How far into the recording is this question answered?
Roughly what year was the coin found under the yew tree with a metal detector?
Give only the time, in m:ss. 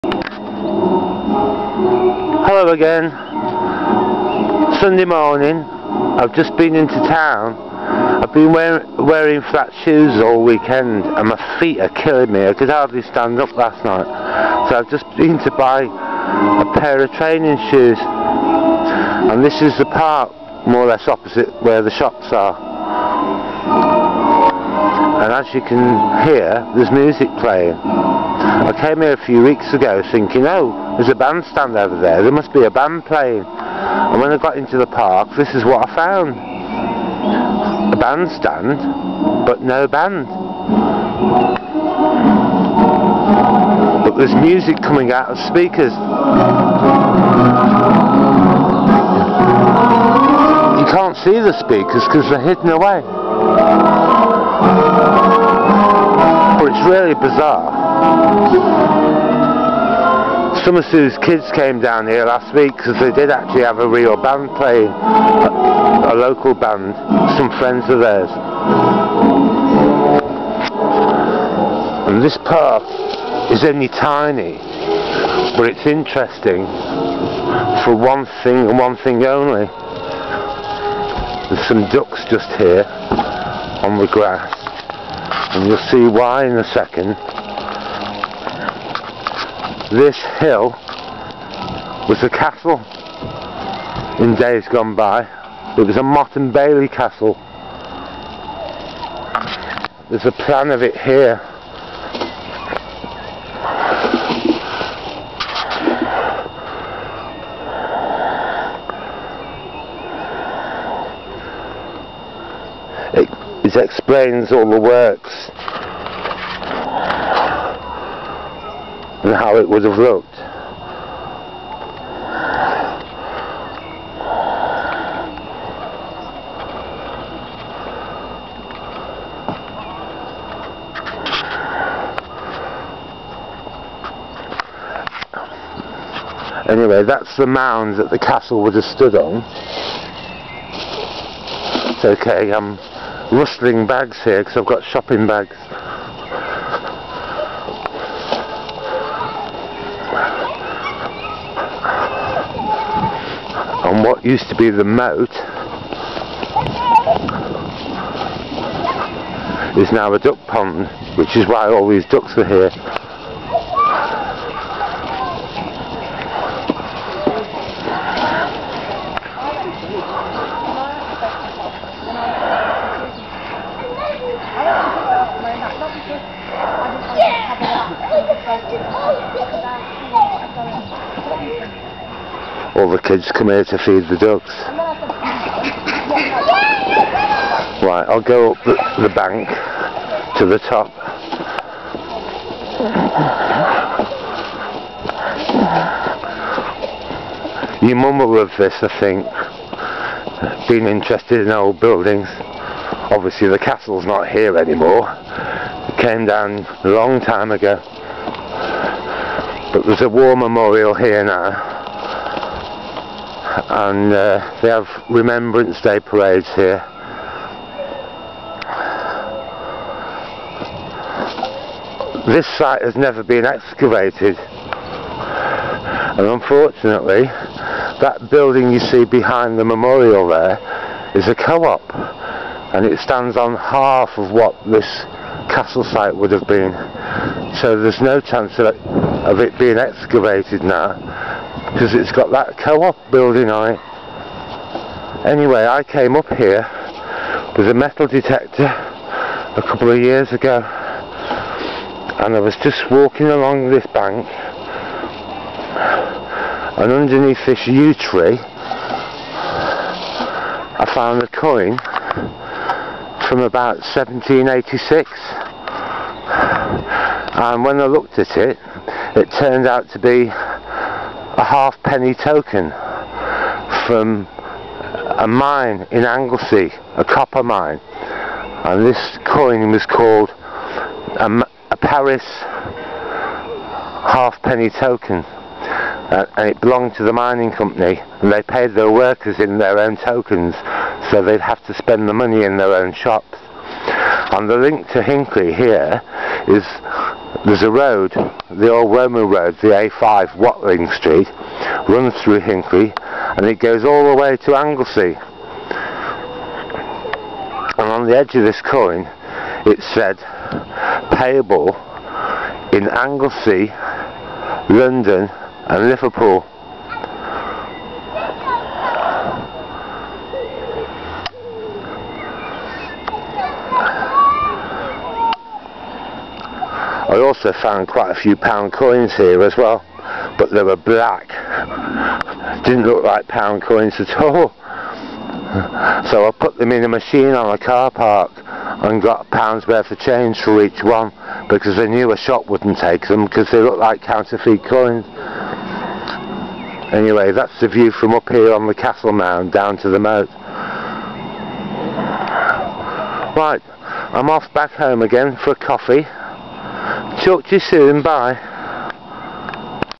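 4:23.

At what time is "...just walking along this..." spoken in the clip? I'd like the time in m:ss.
4:12.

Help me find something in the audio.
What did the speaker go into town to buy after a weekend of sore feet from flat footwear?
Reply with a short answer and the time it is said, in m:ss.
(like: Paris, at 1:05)
training shoes, at 0:17.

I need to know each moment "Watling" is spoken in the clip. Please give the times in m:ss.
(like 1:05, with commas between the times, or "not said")
5:00.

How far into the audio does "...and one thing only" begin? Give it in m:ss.
1:18.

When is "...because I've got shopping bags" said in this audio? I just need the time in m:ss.
2:24.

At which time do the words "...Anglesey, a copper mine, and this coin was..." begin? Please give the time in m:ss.
4:36.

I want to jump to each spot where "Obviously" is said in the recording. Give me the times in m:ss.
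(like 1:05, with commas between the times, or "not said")
3:22.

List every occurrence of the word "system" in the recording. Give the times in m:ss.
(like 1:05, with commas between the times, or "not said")
not said.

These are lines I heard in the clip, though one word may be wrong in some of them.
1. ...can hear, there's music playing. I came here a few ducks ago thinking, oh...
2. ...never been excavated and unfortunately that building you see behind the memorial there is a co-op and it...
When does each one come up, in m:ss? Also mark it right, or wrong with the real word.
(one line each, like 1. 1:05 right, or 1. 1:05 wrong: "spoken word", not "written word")
1. 0:25 wrong: "weeks", not "ducks"
2. 3:42 right.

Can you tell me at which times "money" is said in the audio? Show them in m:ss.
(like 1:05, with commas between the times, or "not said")
4:52.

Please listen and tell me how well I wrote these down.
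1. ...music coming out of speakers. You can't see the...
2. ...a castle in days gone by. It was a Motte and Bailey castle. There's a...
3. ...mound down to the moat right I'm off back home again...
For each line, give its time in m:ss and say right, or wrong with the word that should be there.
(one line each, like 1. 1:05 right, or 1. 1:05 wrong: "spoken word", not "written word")
1. 0:44 right
2. 1:32 right
3. 5:49 right.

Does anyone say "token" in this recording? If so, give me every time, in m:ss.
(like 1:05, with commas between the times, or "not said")
4:32, 4:44, 4:49.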